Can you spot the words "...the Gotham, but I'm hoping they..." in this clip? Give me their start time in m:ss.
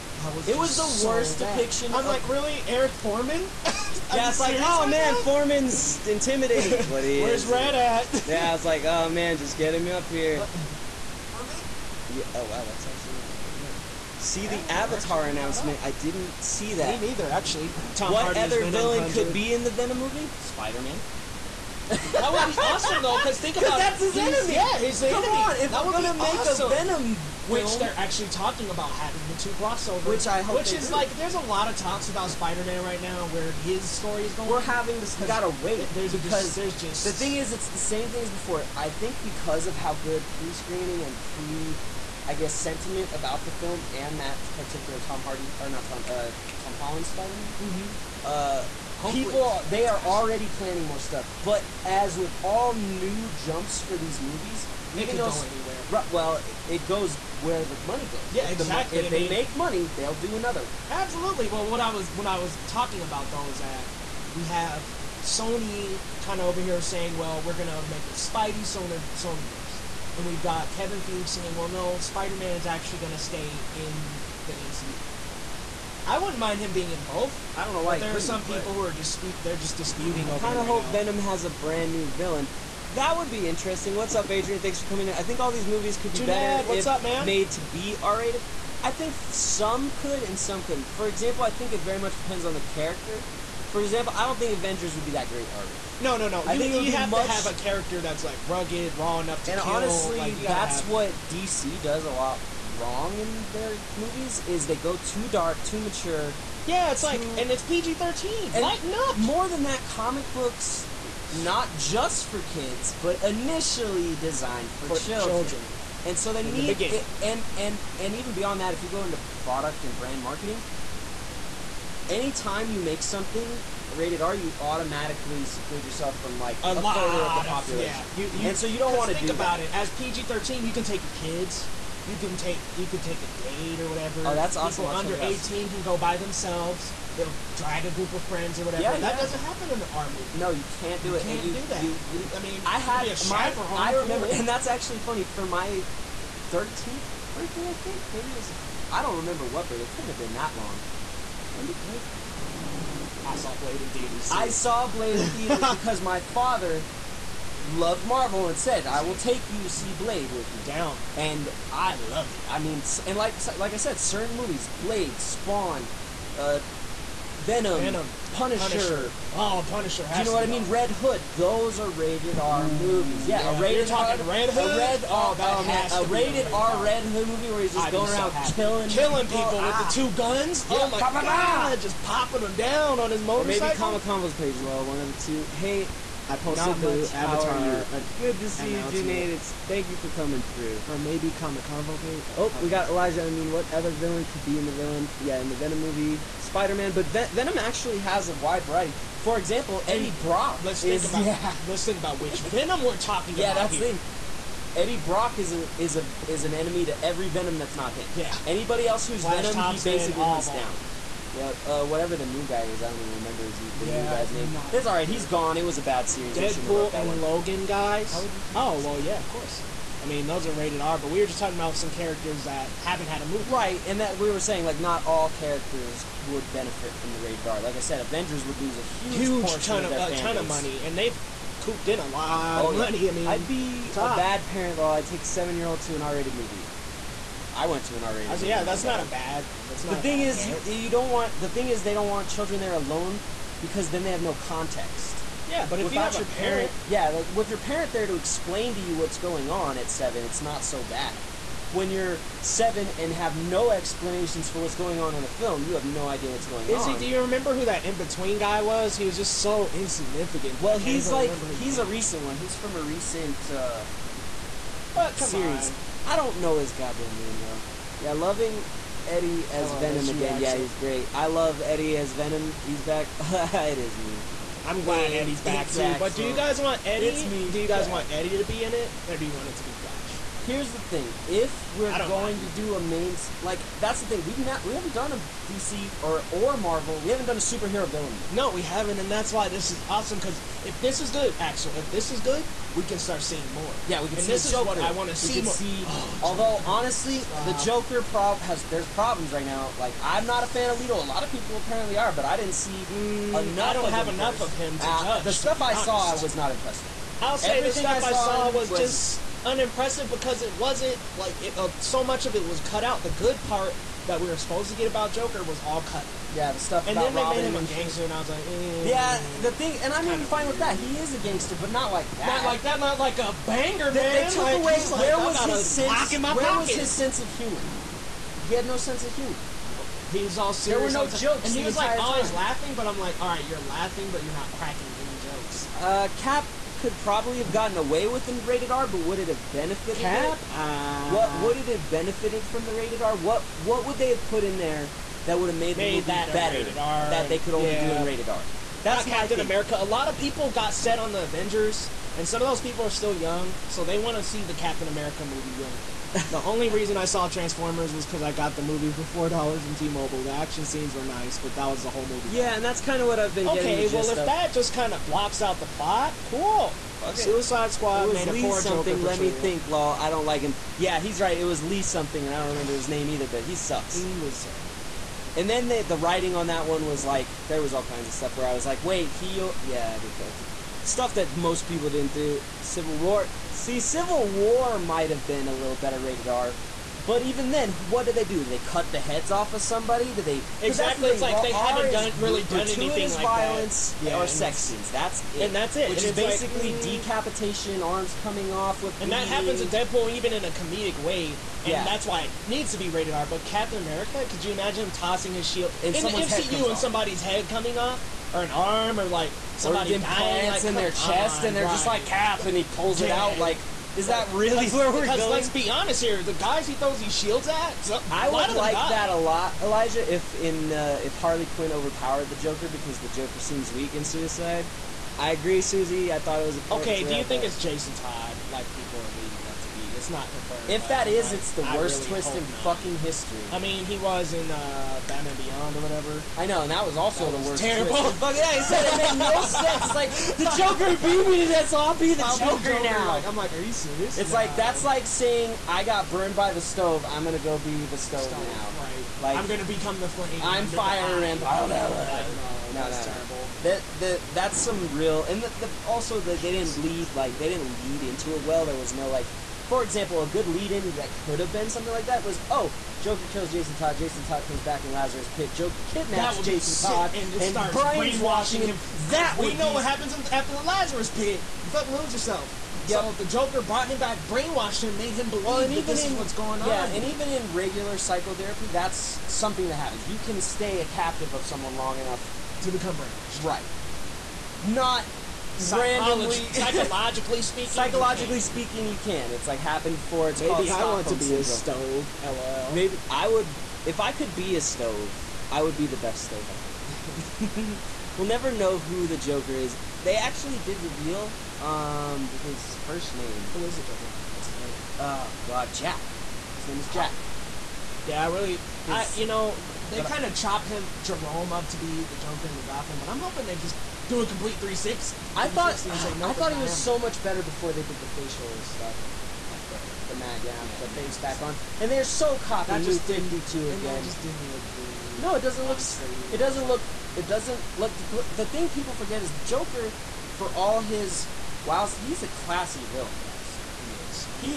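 8:32.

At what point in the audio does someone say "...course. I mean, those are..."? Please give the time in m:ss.
3:39.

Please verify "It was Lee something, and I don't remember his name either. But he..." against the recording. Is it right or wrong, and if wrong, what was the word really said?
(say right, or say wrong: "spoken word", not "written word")
right.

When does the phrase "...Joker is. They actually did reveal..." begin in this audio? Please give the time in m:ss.
8:19.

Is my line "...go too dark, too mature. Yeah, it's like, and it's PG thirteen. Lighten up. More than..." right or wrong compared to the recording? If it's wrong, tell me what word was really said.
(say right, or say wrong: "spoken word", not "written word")
right.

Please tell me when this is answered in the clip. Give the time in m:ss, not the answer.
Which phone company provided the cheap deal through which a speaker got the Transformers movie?
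5:59.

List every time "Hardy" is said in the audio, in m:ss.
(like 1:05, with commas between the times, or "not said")
0:18, 0:45.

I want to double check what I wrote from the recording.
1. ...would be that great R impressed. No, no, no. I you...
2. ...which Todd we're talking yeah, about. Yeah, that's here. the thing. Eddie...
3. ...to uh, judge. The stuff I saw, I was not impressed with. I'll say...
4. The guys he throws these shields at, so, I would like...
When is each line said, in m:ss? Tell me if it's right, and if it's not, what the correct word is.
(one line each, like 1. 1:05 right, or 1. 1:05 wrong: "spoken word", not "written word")
1. 1:34 wrong: "rated", not "impressed"
2. 3:22 wrong: "Venom", not "Todd"
3. 5:04 right
4. 6:56 right.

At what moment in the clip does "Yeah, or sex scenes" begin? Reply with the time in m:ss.
6:34.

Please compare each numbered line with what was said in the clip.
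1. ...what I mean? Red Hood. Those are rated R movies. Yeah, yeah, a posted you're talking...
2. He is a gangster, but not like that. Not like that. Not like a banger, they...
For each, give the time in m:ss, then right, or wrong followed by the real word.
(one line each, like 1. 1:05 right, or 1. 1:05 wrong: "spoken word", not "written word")
1. 2:50 wrong: "rated", not "posted"
2. 5:20 right.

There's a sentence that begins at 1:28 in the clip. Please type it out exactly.
I think some could and some couldn't.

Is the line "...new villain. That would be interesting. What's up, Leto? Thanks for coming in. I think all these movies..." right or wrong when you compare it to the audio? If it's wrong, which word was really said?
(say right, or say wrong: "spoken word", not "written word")
wrong: "Adrian", not "Leto".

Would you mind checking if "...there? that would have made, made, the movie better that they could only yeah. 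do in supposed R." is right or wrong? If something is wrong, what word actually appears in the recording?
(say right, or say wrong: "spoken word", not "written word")
wrong: "rated", not "supposed".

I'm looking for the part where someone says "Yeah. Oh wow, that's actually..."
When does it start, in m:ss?
0:12.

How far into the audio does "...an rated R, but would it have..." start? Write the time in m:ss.
5:38.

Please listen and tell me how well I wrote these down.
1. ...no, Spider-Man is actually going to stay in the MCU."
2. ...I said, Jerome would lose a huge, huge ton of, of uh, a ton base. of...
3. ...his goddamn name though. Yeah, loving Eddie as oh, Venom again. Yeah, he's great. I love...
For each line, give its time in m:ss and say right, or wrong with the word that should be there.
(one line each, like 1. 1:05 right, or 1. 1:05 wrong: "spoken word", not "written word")
1. 1:11 right
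2. 3:47 wrong: "Avengers", not "Jerome"
3. 4:26 right.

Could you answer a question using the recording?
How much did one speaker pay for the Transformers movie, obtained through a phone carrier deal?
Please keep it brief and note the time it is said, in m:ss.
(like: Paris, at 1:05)
4 dollars, at 5:59.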